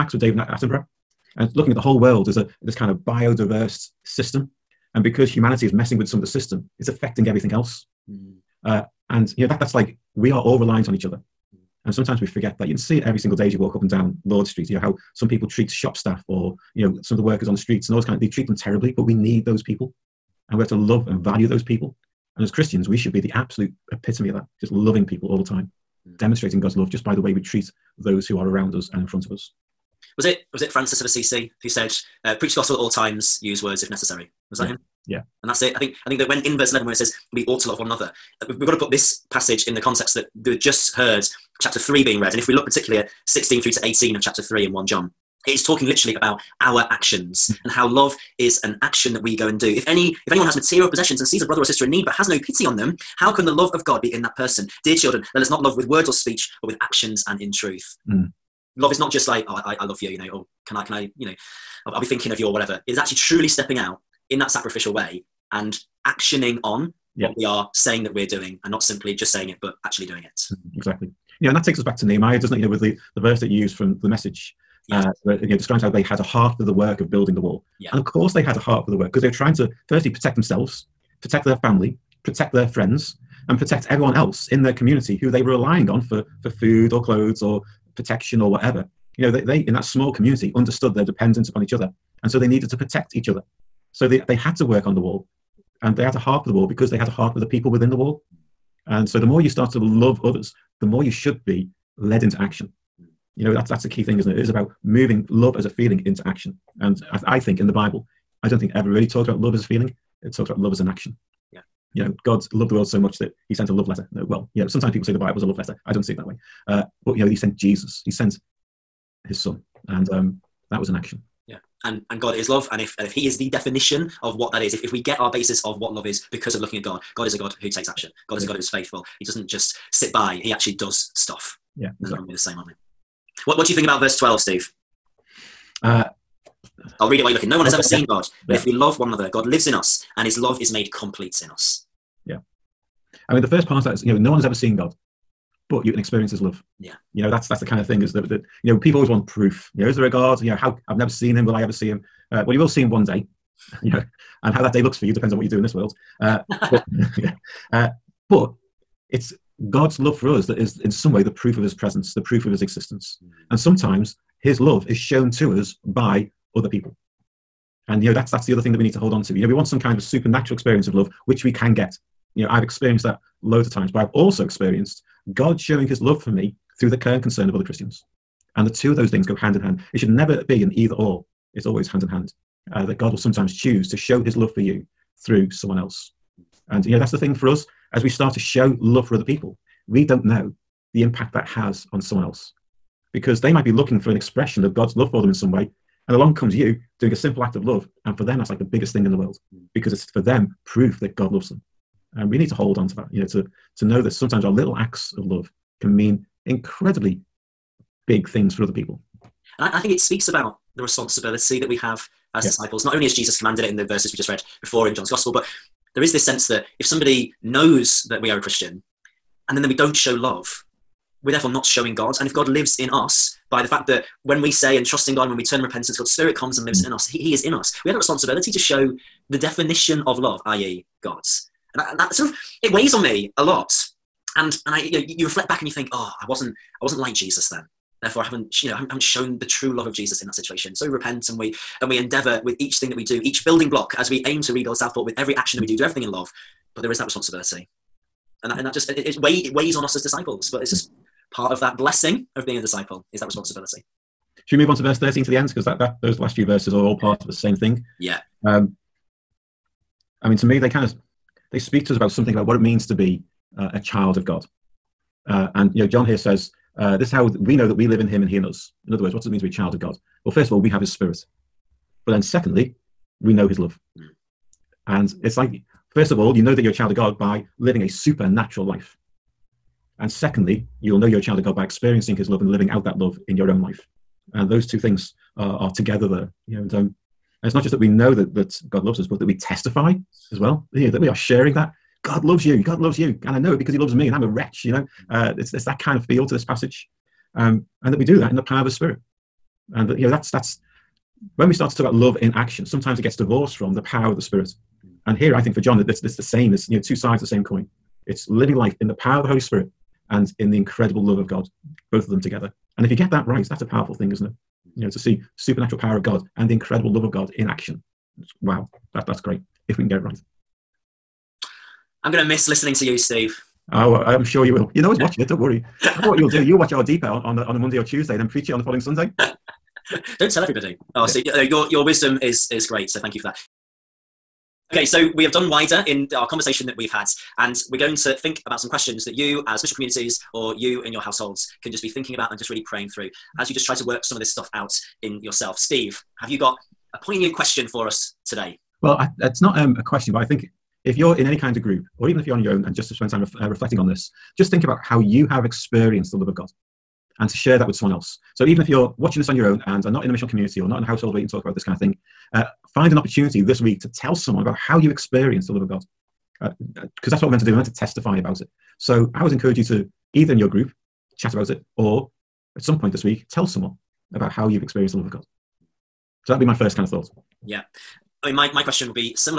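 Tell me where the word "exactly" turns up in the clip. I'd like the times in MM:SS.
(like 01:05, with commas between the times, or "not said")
01:10, 02:12.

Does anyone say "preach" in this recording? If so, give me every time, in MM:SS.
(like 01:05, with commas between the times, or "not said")
00:32, 05:28.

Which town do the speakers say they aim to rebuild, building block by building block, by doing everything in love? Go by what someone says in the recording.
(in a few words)
Southport.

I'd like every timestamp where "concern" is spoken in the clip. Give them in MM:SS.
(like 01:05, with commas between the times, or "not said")
02:57.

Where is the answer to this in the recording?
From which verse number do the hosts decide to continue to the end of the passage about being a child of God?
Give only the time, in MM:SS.
04:14.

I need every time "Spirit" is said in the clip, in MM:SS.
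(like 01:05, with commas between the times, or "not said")
03:46, 04:30, 04:58, 05:04, 05:09.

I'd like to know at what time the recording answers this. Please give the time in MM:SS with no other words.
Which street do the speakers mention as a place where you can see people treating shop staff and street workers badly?
00:14.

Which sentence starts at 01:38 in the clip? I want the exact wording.
And so the more you start to love others, the more you should be led into action.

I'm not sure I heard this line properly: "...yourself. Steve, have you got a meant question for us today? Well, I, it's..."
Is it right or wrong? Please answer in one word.
wrong.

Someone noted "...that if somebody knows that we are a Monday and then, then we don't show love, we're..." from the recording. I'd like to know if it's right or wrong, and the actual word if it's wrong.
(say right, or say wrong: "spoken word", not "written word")
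wrong: "Christian", not "Monday".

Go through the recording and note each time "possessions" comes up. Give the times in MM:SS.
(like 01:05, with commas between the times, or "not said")
00:50.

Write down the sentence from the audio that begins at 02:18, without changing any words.
if we love one another, God lives in us and his love is made complete in us.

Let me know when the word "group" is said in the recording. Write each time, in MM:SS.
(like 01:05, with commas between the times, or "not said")
05:51, 06:10.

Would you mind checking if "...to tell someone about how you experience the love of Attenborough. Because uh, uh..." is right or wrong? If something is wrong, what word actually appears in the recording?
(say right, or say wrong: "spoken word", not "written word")
wrong: "God", not "Attenborough".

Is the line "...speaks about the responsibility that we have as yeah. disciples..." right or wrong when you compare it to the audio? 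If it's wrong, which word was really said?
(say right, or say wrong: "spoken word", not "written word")
right.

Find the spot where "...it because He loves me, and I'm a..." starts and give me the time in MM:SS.
04:53.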